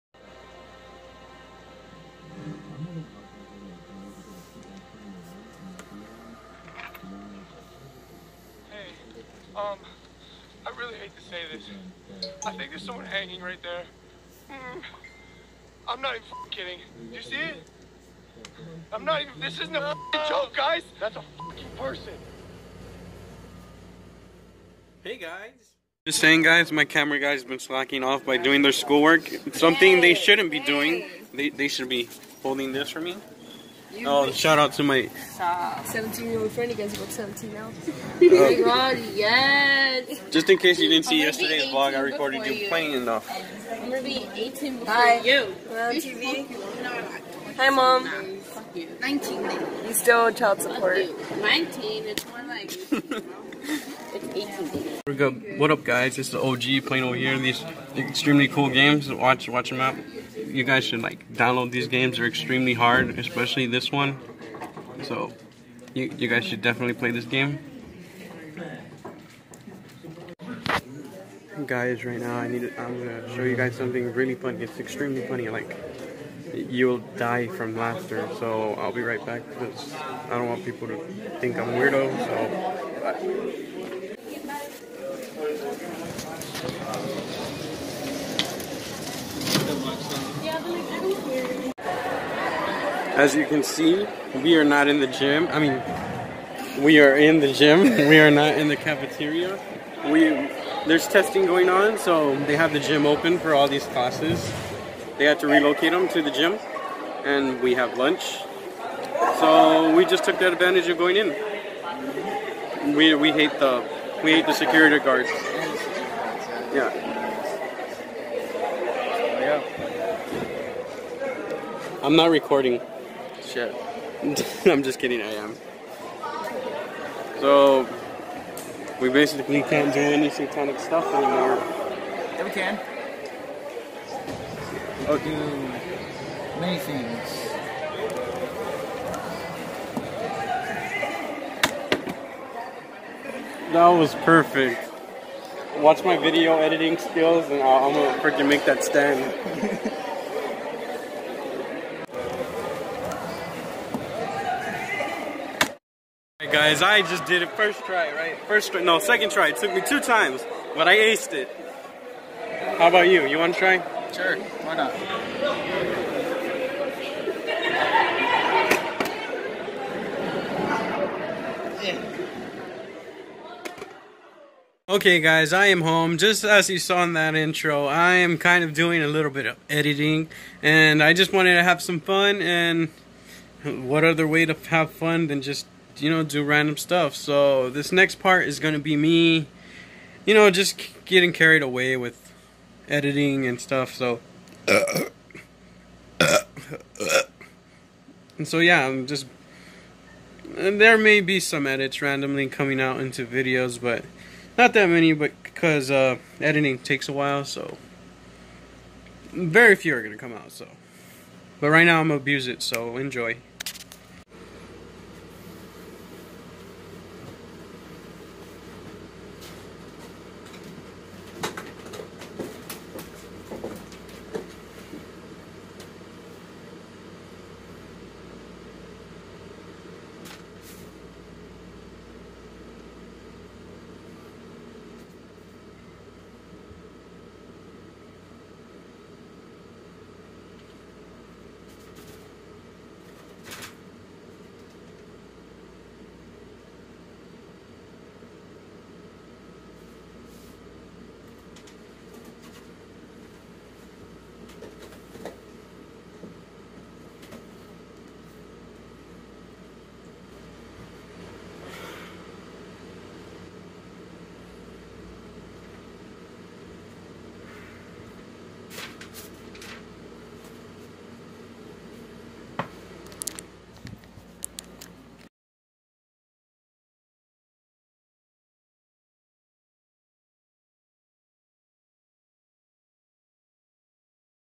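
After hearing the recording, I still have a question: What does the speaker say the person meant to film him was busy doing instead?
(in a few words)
schoolwork.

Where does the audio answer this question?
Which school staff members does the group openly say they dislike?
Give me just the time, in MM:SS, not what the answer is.
01:54.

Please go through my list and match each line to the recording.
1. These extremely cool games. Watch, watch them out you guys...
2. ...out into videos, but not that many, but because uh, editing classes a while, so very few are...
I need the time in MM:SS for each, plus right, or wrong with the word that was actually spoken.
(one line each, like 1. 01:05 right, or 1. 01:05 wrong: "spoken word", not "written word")
1. 00:57 right
2. 03:22 wrong: "takes", not "classes".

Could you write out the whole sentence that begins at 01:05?
So you, you guys should definitely play this game.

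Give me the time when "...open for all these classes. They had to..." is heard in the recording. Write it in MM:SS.
01:43.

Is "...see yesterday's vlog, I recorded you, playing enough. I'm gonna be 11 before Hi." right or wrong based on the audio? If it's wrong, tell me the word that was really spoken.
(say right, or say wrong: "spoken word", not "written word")
wrong: "18", not "11".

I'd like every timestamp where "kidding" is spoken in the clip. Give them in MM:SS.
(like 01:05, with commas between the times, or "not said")
00:16, 02:04.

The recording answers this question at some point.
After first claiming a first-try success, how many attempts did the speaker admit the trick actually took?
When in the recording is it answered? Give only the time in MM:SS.
02:39.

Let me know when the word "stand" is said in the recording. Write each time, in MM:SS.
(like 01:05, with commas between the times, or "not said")
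02:28.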